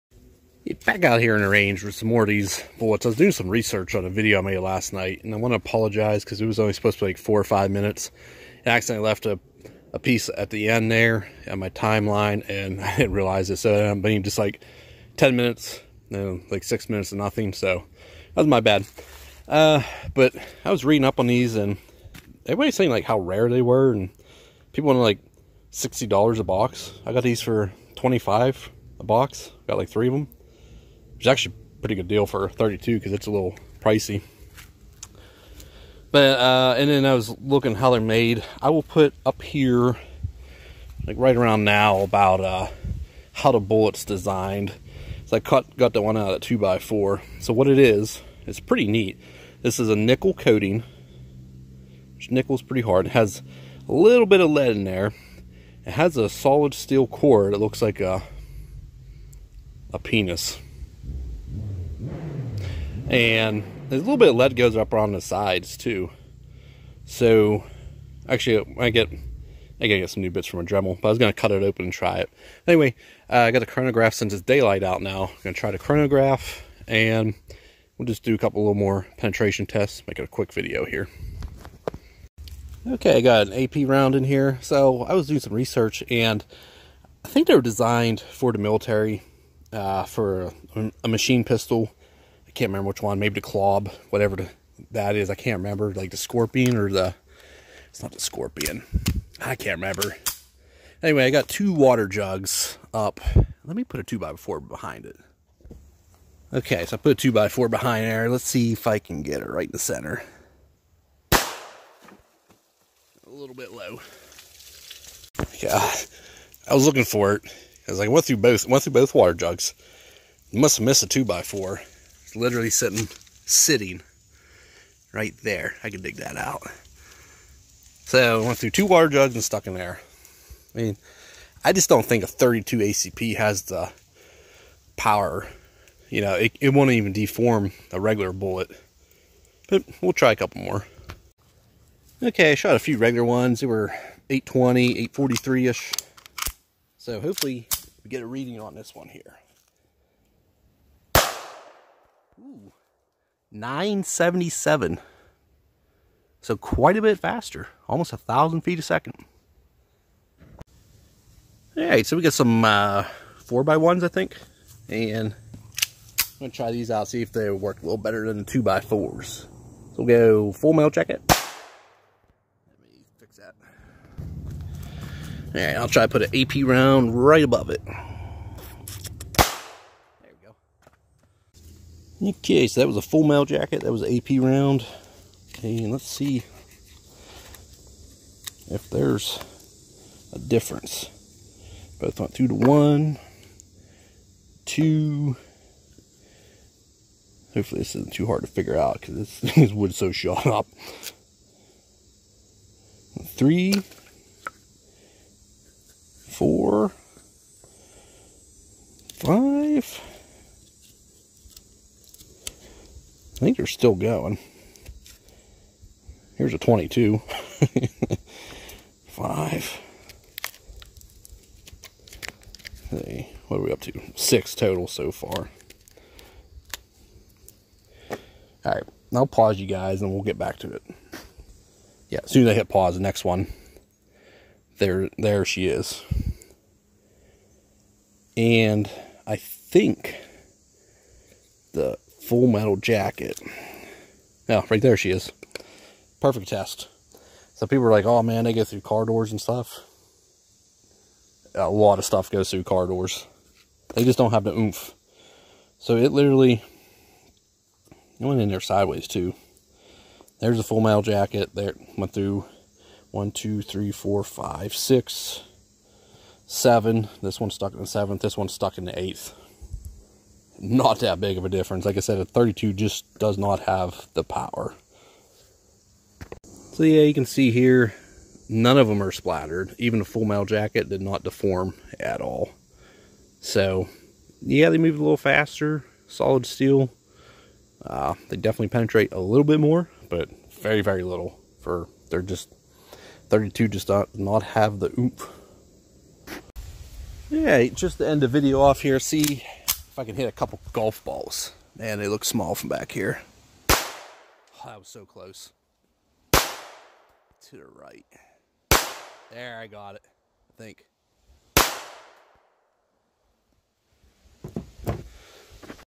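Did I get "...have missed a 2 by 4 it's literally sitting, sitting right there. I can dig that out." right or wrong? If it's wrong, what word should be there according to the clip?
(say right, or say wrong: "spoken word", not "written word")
right.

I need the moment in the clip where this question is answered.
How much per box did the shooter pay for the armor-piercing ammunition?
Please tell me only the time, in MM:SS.
00:27.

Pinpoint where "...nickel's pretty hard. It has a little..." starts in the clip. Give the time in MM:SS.
00:52.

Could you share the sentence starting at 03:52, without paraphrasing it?
Yeah, as soon as I hit pause, the next one.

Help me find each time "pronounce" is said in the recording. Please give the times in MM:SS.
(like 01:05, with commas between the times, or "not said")
not said.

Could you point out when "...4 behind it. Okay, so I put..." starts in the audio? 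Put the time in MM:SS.
01:44.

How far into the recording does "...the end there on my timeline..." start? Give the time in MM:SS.
00:10.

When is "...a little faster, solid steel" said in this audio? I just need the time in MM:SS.
04:44.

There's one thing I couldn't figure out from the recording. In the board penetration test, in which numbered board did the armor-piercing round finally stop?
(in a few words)
eighth.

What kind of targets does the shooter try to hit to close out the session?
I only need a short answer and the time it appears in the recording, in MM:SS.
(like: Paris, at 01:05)
golf balls, at 05:00.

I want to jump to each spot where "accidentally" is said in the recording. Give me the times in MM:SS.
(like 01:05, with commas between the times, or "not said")
00:08.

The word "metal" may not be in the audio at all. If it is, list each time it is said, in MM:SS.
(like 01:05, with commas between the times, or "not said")
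02:50, 03:03, 04:02, 04:20, 04:40.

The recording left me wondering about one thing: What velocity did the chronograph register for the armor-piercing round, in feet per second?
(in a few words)
977.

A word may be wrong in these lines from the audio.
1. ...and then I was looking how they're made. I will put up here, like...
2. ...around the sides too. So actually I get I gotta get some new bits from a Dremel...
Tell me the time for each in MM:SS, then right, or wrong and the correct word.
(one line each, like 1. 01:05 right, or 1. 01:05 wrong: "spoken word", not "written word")
1. 00:36 right
2. 01:04 right.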